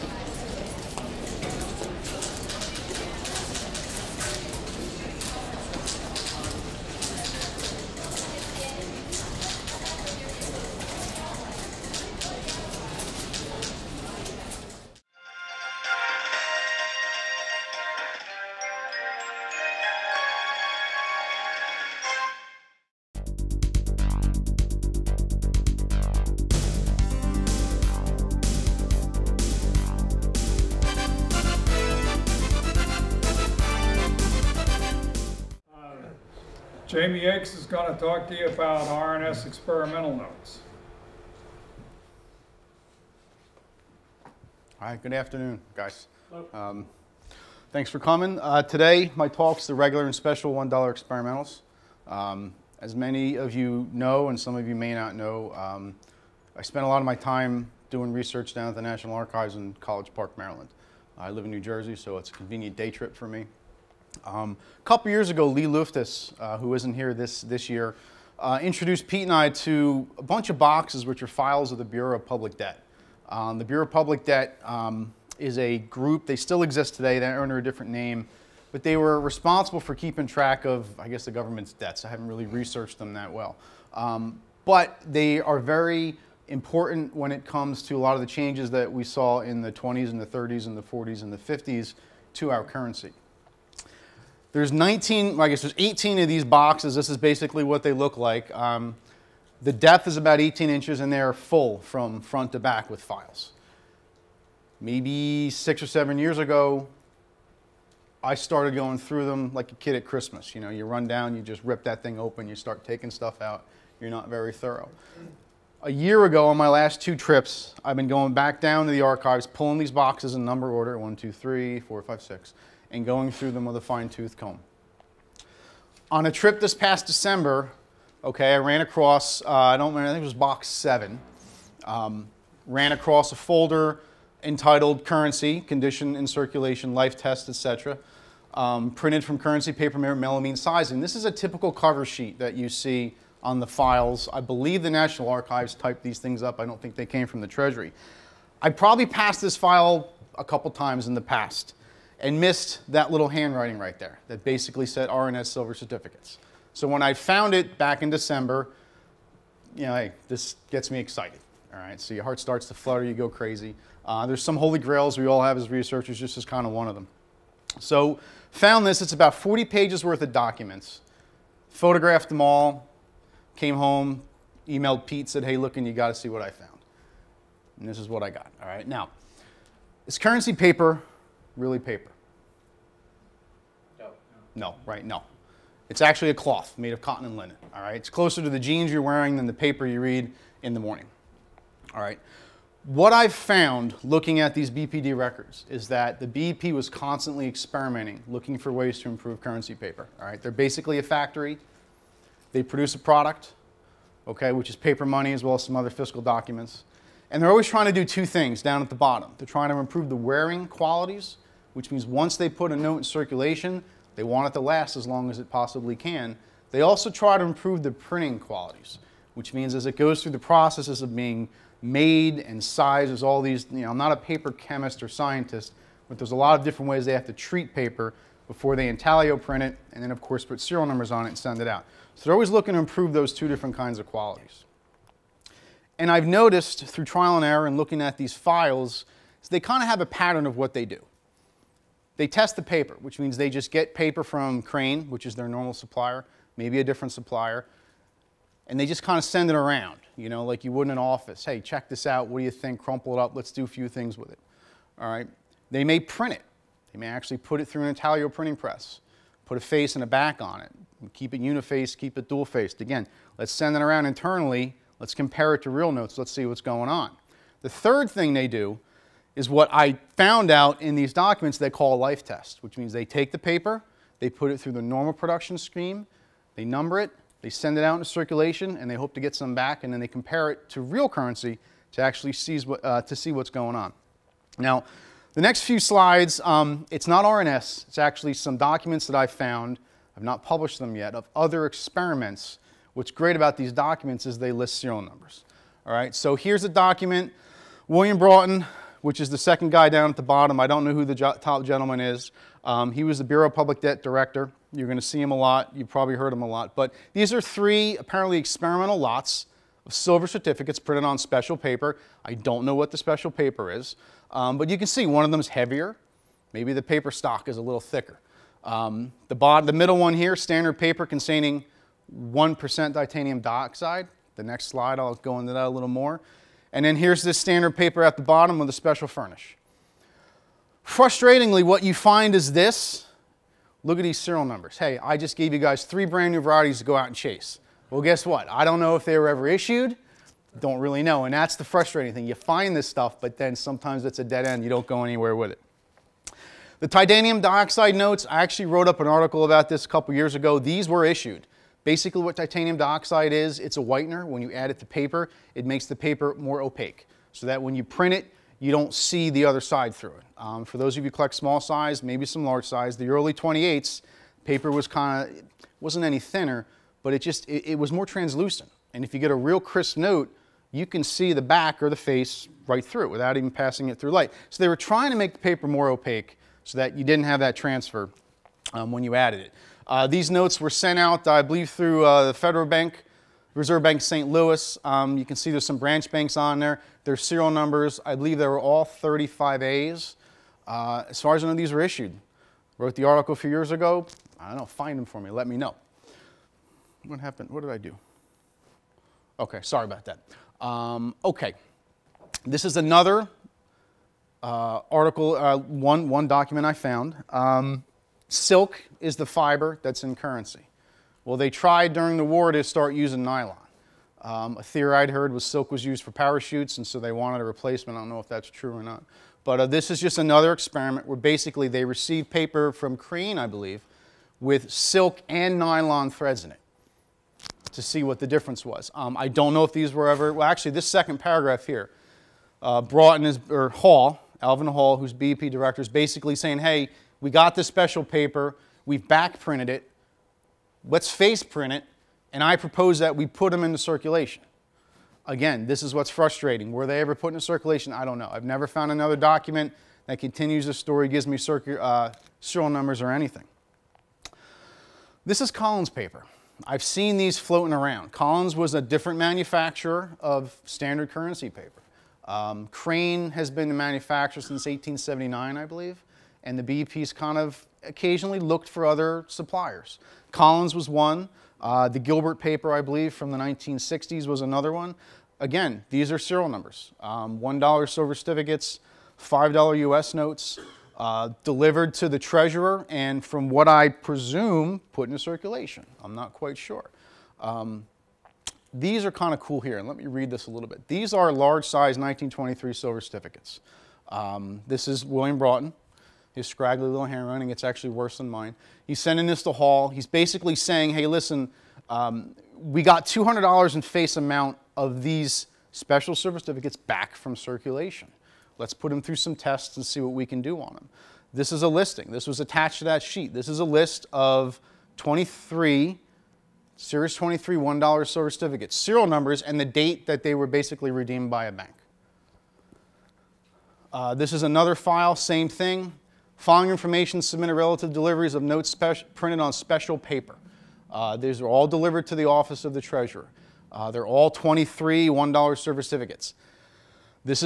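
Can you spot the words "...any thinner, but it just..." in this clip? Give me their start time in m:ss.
6:06.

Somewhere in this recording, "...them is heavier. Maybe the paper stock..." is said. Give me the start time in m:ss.
5:15.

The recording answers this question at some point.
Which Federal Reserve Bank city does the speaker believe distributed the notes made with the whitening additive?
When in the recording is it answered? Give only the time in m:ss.
6:24.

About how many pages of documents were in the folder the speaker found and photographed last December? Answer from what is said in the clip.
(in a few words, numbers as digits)
40.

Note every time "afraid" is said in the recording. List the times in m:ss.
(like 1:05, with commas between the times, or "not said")
not said.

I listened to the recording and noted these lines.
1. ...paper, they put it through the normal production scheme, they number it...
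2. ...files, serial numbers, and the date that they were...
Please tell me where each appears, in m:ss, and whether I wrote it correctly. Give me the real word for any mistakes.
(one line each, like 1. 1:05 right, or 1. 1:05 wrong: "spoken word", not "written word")
1. 4:33 right
2. 8:38 wrong: "certificates", not "files".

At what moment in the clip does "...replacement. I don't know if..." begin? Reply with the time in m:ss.
6:57.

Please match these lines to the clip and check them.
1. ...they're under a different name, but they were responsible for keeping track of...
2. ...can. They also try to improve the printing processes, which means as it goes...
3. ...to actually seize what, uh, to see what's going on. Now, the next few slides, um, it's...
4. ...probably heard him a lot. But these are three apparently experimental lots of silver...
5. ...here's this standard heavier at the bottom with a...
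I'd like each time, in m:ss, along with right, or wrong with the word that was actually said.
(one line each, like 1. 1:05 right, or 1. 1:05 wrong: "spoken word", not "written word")
1. 1:17 right
2. 3:35 wrong: "qualities", not "processes"
3. 4:41 right
4. 5:05 right
5. 5:26 wrong: "paper", not "heavier".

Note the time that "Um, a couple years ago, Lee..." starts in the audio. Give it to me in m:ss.
1:04.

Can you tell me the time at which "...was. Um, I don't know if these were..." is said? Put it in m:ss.
7:08.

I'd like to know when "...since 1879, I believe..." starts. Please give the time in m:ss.
7:44.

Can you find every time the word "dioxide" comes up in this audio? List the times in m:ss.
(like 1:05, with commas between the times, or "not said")
5:23, 5:47, 5:52.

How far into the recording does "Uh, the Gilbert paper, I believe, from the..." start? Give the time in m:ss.
7:51.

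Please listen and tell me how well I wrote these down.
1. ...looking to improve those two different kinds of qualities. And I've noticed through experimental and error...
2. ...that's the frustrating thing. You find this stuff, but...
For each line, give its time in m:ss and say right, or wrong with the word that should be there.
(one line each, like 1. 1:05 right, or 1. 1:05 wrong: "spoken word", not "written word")
1. 3:52 wrong: "trial", not "experimental"
2. 5:41 right.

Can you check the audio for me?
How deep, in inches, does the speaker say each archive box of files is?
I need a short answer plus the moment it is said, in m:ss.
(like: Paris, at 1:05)
18 inches, at 1:40.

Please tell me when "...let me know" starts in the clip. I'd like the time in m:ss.
6:35.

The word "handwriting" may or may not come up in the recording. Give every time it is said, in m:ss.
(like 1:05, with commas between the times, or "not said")
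2:33, 8:17.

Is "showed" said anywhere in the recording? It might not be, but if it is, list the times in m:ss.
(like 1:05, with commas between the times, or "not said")
not said.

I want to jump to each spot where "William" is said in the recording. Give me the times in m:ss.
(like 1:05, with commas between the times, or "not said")
4:57, 8:15.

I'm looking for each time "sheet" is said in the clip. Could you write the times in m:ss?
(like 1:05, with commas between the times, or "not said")
2:22, 8:33.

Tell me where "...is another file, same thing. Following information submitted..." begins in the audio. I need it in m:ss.
8:44.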